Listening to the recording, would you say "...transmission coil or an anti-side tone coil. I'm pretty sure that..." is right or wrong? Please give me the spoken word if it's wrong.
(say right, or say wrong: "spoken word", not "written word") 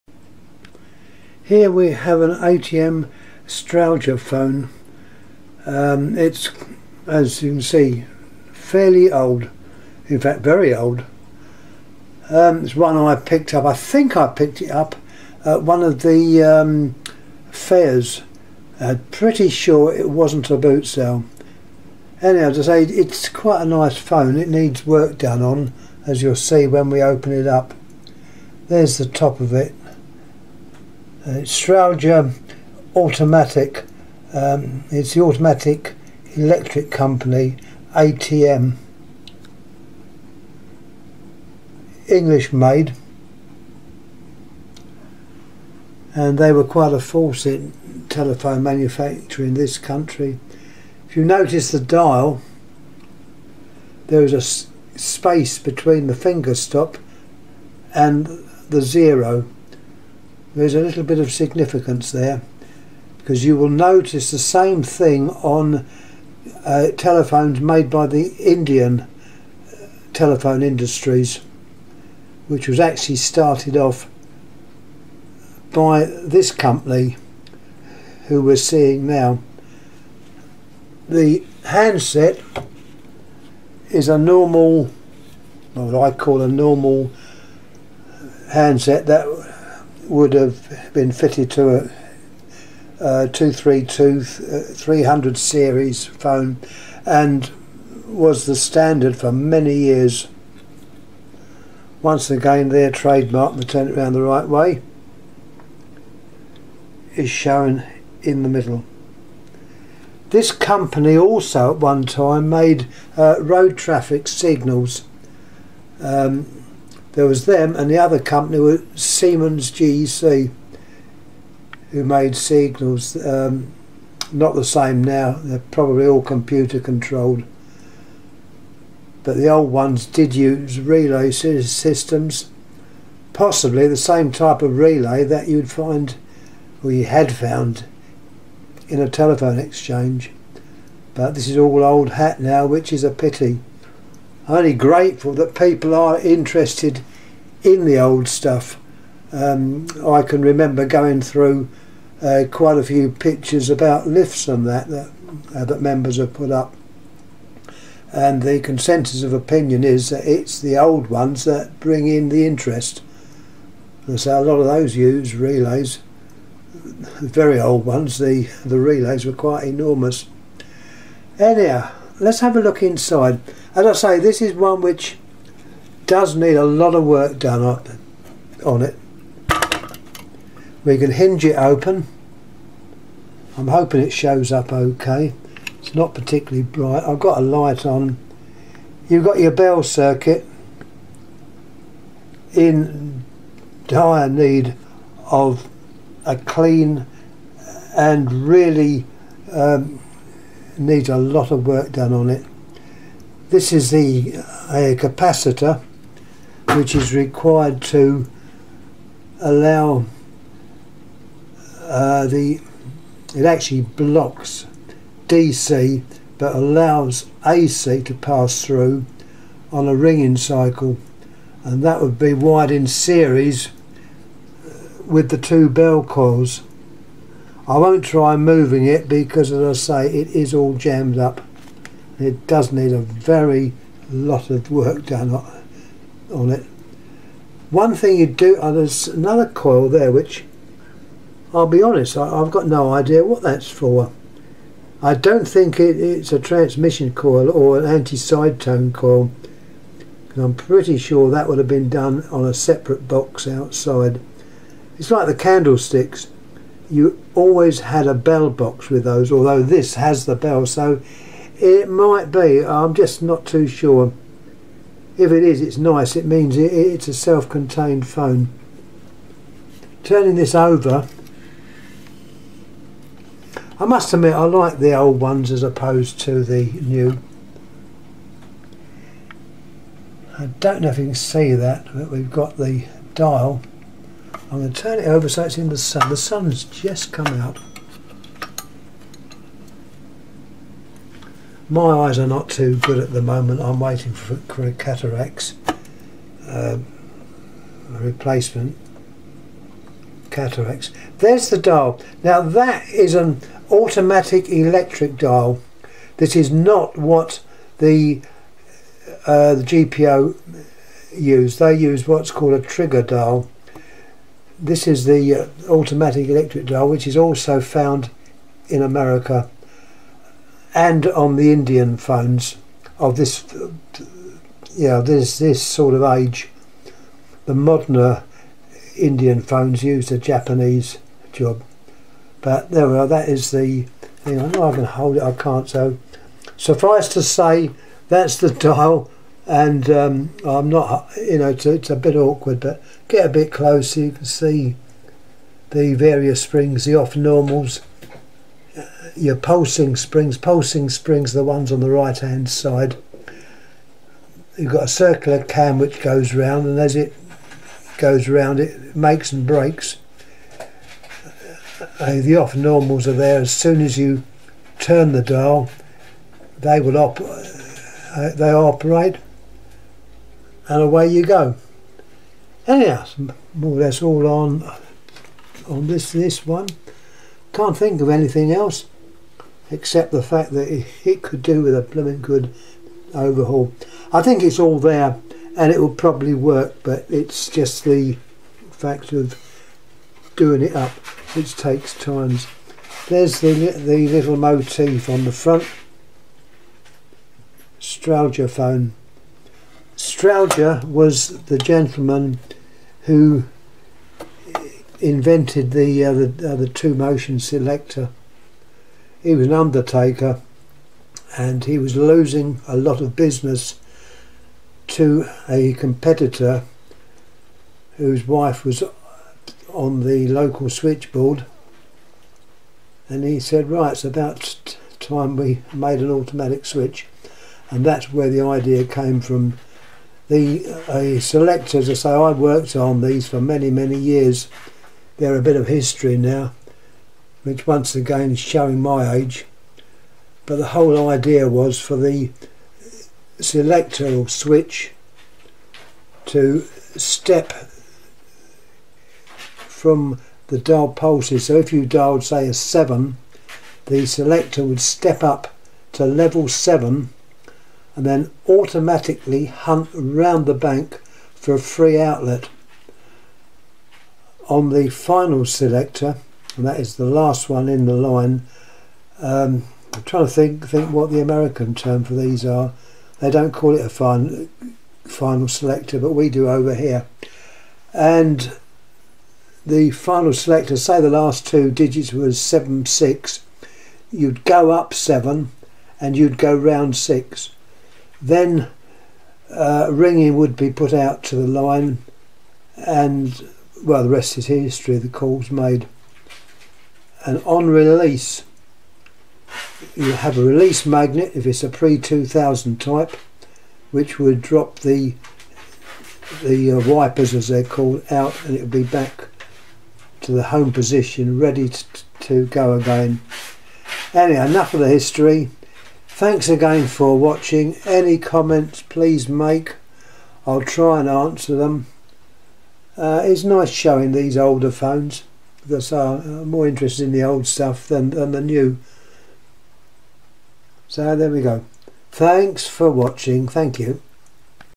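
right.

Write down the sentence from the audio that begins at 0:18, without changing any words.
I'm uh, pretty sure it wasn't a boot sale.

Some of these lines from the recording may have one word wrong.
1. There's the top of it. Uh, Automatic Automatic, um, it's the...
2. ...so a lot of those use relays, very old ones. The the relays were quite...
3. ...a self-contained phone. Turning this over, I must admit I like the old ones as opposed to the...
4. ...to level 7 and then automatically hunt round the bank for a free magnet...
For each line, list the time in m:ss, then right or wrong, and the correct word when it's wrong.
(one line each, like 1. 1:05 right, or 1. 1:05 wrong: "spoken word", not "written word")
1. 0:28 wrong: "Strowger", not "Automatic"
2. 2:44 right
3. 4:27 right
4. 7:35 wrong: "outlet", not "magnet".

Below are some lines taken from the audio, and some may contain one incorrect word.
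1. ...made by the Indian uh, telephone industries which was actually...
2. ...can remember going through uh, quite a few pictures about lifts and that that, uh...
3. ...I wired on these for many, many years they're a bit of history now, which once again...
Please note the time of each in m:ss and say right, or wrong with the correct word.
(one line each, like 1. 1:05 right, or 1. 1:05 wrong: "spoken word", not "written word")
1. 1:07 right
2. 2:30 right
3. 7:12 wrong: "worked", not "wired".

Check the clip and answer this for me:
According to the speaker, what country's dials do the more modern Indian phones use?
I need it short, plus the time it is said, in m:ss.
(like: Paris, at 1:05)
Japanese, at 5:30.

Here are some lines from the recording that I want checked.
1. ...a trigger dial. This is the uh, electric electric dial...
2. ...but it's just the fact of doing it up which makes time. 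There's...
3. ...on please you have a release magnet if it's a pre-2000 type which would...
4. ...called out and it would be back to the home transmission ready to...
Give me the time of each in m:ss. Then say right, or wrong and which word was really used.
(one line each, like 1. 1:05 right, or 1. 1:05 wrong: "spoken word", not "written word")
1. 5:12 wrong: "automatic", not "electric"
2. 6:26 wrong: "takes", not "makes"
3. 8:17 wrong: "release", not "please"
4. 8:27 wrong: "position", not "transmission".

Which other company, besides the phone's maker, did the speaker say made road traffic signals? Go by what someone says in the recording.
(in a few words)
Siemens GEC.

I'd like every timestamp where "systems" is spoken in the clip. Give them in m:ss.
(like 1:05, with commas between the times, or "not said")
2:11.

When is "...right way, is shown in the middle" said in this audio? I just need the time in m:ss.
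1:44.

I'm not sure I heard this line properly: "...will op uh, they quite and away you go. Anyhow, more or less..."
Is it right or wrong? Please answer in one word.
wrong.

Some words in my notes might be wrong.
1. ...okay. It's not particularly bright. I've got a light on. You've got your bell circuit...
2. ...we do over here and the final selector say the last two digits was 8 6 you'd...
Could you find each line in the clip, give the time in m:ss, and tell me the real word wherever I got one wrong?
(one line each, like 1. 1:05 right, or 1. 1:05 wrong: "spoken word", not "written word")
1. 3:04 right
2. 7:56 wrong: "7", not "8".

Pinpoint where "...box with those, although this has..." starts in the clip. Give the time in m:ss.
4:18.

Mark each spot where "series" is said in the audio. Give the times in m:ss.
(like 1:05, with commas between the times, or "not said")
1:35, 3:42.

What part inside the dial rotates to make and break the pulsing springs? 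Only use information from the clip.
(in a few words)
circular cam.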